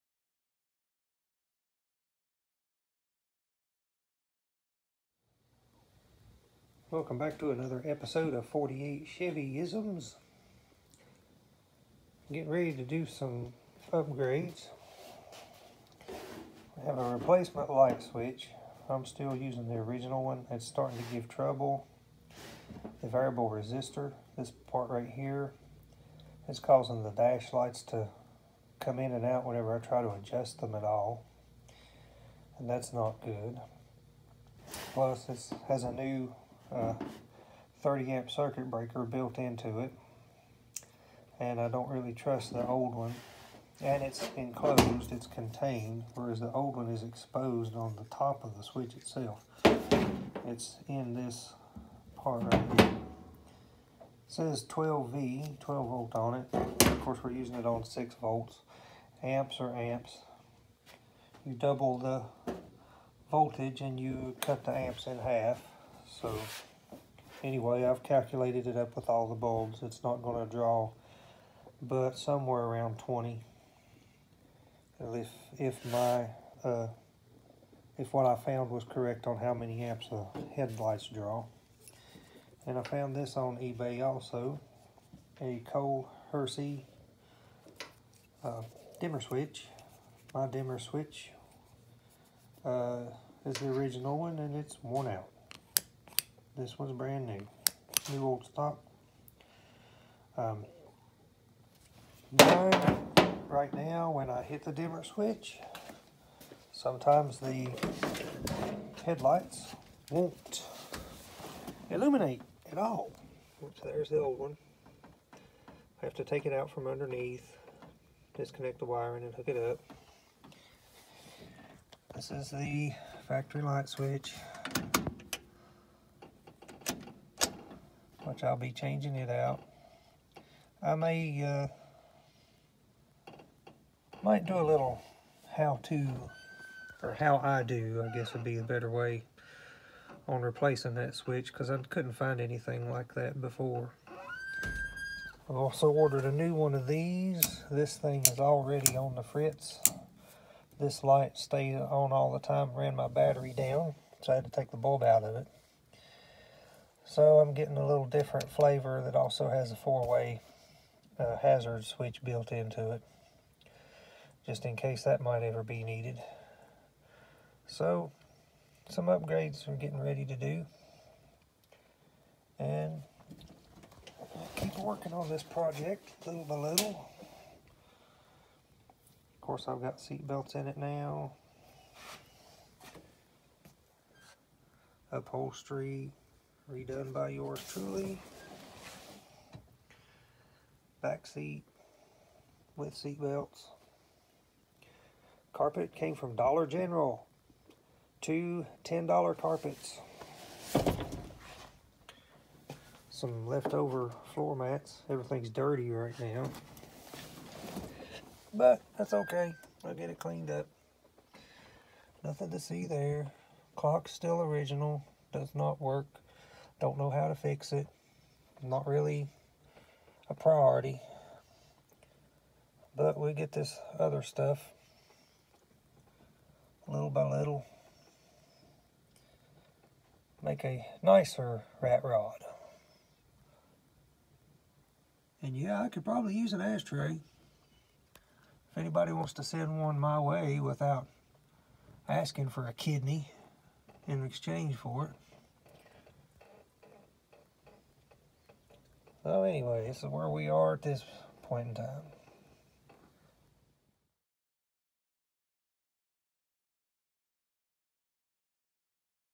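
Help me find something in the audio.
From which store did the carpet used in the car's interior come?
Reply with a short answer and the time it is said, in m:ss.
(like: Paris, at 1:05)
Dollar General, at 3:16.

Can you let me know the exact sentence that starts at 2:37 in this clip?
So I'm getting a little different flavor that also has a four-way uh, hazard switch built into it.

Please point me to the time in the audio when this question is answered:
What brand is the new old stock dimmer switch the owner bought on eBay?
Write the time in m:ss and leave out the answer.
1:25.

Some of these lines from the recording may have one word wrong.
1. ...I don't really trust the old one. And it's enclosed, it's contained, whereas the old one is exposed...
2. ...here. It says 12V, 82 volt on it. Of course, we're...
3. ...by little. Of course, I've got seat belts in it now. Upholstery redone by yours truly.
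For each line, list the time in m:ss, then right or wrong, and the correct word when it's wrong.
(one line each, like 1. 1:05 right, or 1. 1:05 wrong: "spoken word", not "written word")
1. 0:41 right
2. 0:52 wrong: "12", not "82"
3. 2:56 right.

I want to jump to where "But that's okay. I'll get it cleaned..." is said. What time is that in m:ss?
3:28.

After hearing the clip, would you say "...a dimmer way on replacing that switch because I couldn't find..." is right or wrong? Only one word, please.
wrong.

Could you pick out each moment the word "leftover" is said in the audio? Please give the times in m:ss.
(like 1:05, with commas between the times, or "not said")
3:23.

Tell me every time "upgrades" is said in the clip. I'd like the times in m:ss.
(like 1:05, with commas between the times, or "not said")
0:13, 2:49.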